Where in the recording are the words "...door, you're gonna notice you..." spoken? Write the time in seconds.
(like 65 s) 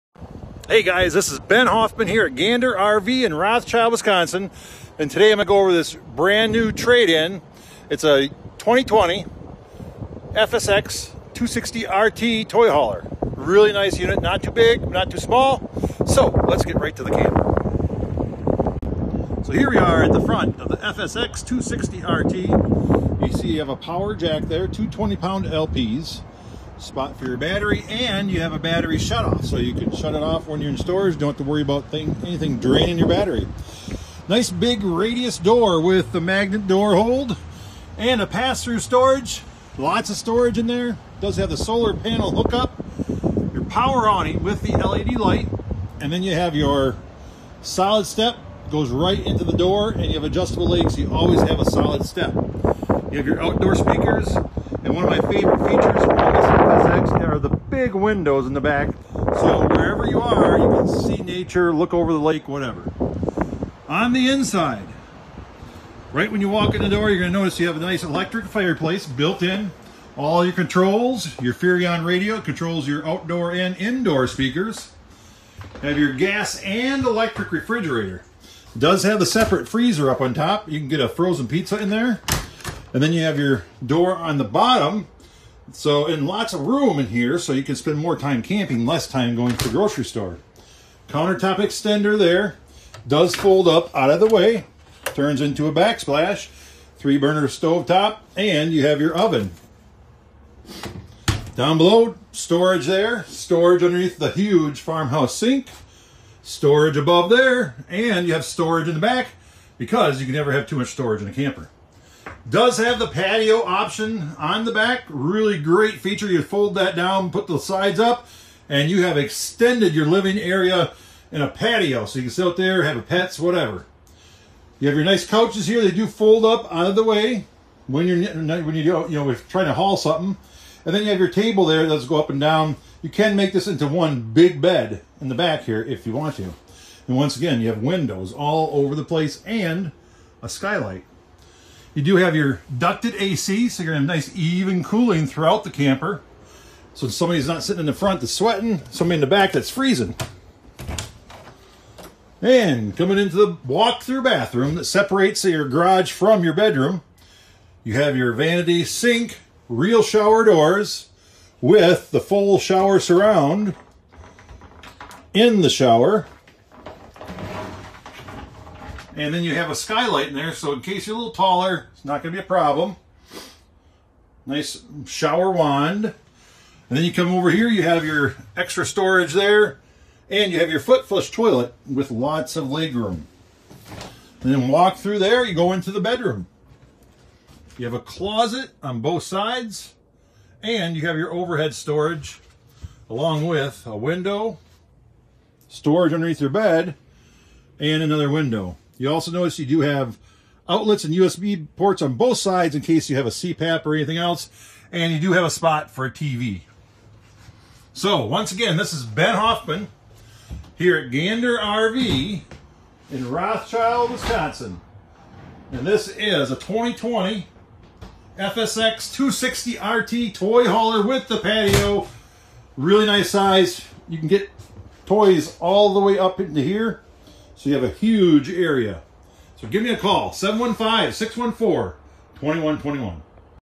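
66 s.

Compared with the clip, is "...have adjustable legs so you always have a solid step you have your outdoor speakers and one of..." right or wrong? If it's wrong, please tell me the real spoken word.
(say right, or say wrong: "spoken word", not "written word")
right.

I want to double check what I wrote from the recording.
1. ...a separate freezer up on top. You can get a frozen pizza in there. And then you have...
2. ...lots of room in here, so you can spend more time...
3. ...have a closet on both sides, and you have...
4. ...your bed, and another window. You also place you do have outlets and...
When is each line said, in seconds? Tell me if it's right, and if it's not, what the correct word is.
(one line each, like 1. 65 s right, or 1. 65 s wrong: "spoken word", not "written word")
1. 79 s right
2. 86 s right
3. 187 s right
4. 196 s wrong: "notice", not "place".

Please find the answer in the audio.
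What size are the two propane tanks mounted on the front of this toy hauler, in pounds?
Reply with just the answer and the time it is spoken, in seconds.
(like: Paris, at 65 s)
20 pounds, at 24 s.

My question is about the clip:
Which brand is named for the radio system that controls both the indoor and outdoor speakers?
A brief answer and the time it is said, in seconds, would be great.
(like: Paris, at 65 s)
Furrion, at 71 s.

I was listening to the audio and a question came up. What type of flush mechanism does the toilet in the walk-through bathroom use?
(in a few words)
Foot flush.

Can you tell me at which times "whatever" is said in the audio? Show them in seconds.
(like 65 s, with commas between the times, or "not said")
62 s, 123 s.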